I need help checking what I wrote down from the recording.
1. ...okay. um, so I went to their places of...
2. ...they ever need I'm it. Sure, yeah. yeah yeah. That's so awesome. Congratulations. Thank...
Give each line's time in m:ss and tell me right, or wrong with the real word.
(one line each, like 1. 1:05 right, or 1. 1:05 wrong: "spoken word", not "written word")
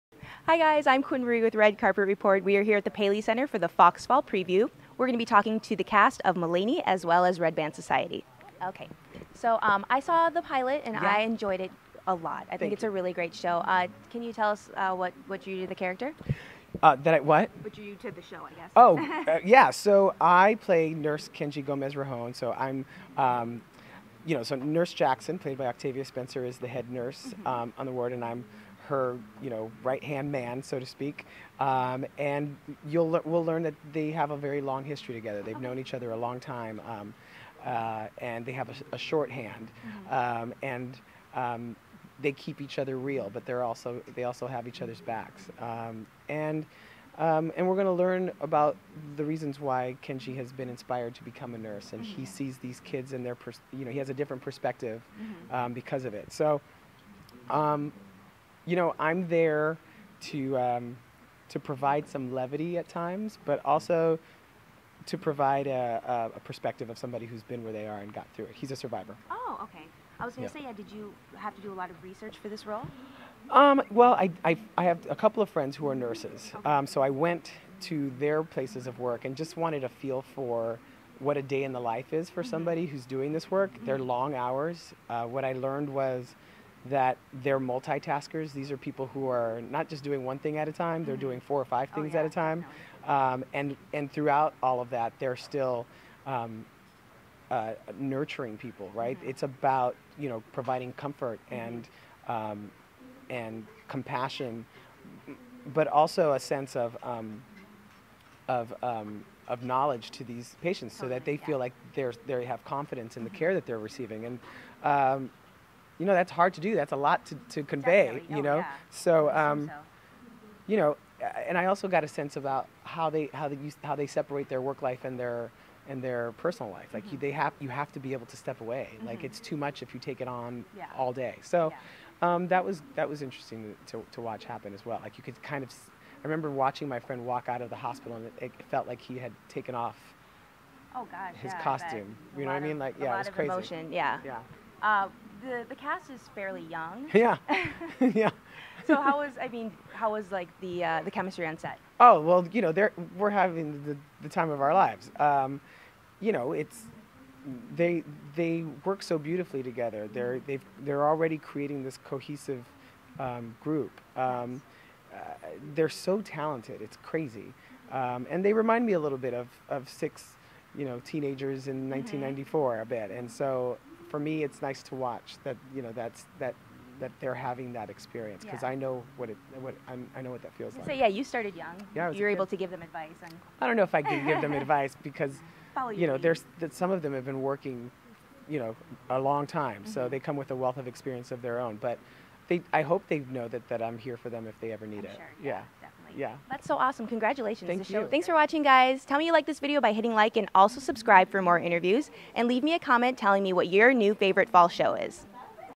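1. 1:16 right
2. 3:14 right.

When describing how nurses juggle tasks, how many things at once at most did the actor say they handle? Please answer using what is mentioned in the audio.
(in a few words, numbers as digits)
5.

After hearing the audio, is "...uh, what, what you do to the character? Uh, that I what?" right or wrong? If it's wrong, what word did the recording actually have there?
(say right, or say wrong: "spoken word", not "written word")
right.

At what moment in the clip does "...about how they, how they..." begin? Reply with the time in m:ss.
2:02.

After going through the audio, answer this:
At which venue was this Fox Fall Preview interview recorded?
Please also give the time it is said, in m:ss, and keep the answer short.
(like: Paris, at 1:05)
Paley Center, at 0:02.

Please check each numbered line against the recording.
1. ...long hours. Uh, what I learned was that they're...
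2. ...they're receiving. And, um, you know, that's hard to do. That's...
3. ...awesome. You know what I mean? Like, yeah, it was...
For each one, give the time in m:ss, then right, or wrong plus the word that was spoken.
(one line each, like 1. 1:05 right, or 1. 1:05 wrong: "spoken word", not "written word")
1. 1:23 right
2. 1:53 right
3. 2:21 wrong: "costume", not "awesome".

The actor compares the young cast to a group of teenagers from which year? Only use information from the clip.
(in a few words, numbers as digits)
1994.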